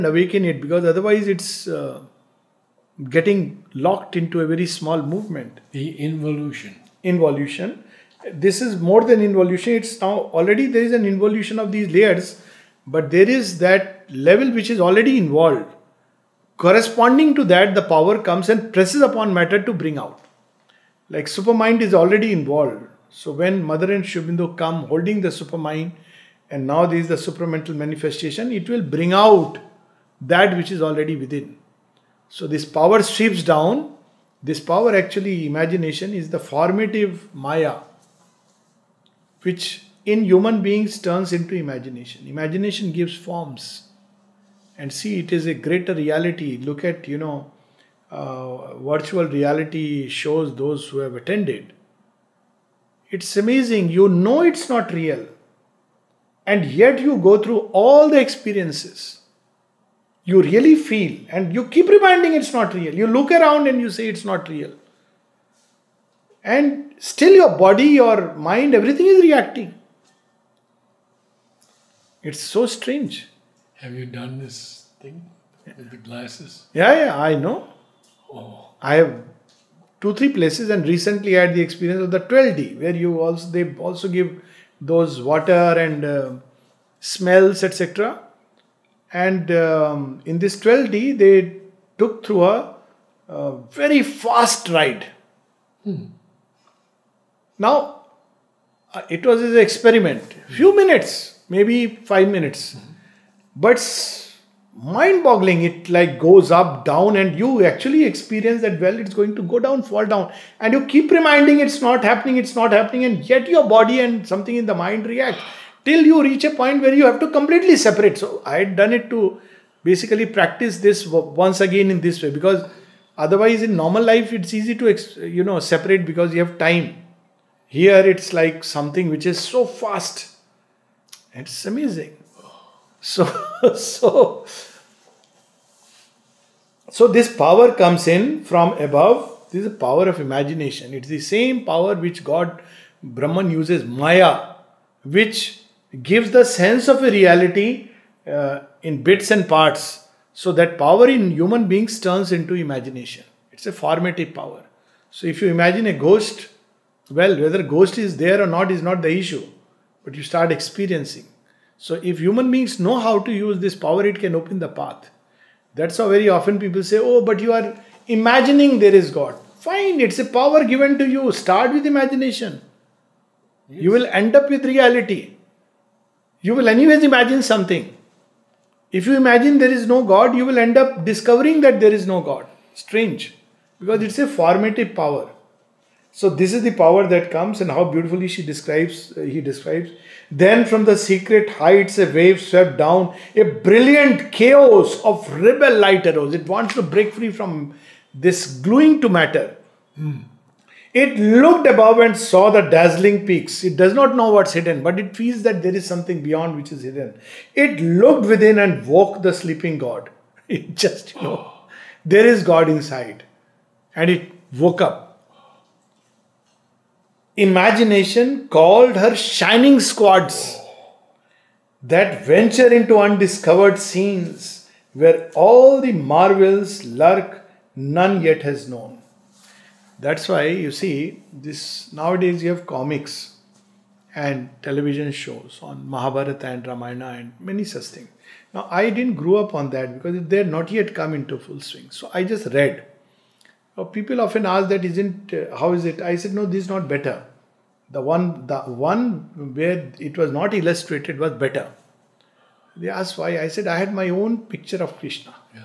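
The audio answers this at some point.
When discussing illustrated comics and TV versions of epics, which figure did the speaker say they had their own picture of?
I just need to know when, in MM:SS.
04:14.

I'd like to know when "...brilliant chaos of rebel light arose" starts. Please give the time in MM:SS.
03:13.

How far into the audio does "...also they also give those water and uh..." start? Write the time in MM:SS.
01:23.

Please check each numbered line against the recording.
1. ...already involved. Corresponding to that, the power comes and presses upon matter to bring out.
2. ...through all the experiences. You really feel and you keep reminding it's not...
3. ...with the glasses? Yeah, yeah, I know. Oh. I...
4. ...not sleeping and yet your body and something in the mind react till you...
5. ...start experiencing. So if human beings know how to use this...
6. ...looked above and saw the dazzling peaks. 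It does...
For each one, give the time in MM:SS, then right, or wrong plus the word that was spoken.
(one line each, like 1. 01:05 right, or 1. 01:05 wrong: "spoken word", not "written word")
1. 00:14 right
2. 00:57 right
3. 01:15 right
4. 01:52 wrong: "happening", not "sleeping"
5. 02:40 right
6. 03:21 right.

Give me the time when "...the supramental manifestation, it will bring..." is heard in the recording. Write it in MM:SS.
00:27.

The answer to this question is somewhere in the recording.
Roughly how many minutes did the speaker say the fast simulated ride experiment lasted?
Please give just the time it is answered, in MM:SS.
01:42.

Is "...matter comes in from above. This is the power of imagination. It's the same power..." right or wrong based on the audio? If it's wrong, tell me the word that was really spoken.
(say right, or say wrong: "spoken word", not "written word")
wrong: "power", not "matter".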